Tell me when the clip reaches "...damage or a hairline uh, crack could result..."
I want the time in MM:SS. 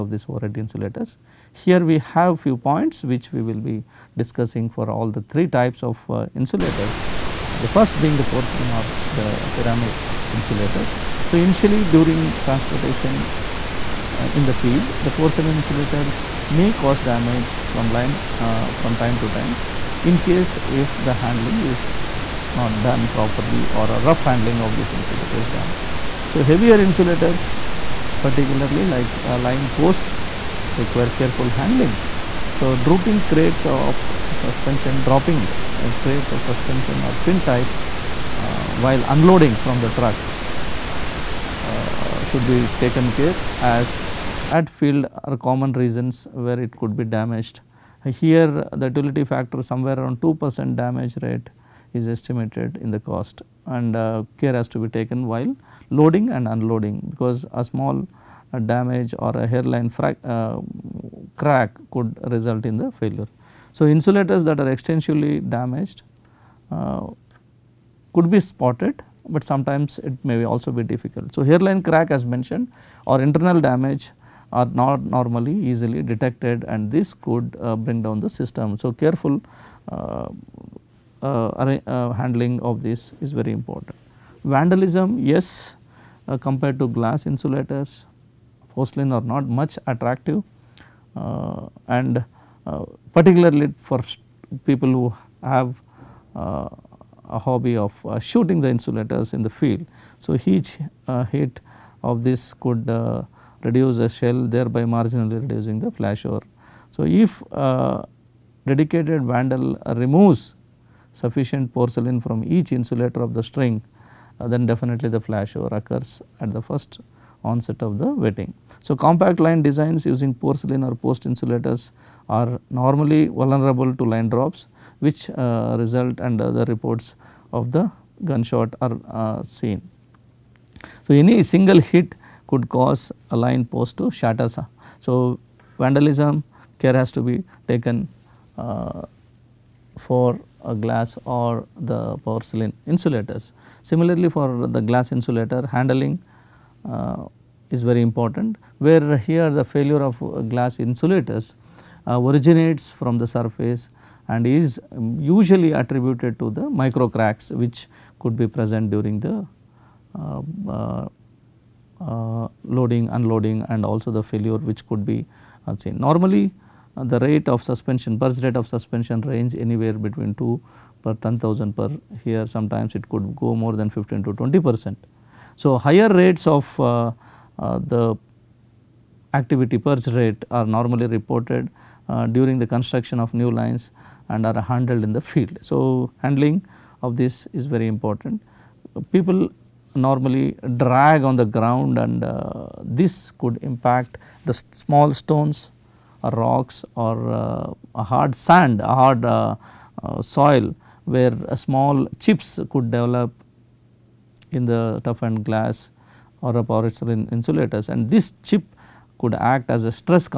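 00:58.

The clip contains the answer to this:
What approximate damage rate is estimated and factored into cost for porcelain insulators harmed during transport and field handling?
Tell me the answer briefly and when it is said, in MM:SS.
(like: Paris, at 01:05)
2 percent, at 00:50.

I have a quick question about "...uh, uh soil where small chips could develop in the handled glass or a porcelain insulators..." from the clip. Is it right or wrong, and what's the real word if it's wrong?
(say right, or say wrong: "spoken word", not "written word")
wrong: "toughened", not "handled".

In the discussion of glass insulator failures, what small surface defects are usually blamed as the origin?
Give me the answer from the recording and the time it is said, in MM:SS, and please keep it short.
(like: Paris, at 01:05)
Micro cracks, at 02:36.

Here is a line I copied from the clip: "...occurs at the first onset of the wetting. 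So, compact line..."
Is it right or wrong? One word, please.
right.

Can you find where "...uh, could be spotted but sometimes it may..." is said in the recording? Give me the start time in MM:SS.
01:06.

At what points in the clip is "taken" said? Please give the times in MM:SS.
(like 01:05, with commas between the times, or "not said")
00:42, 00:54, 02:17.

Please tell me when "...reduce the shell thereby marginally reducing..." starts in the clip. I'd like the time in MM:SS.
01:43.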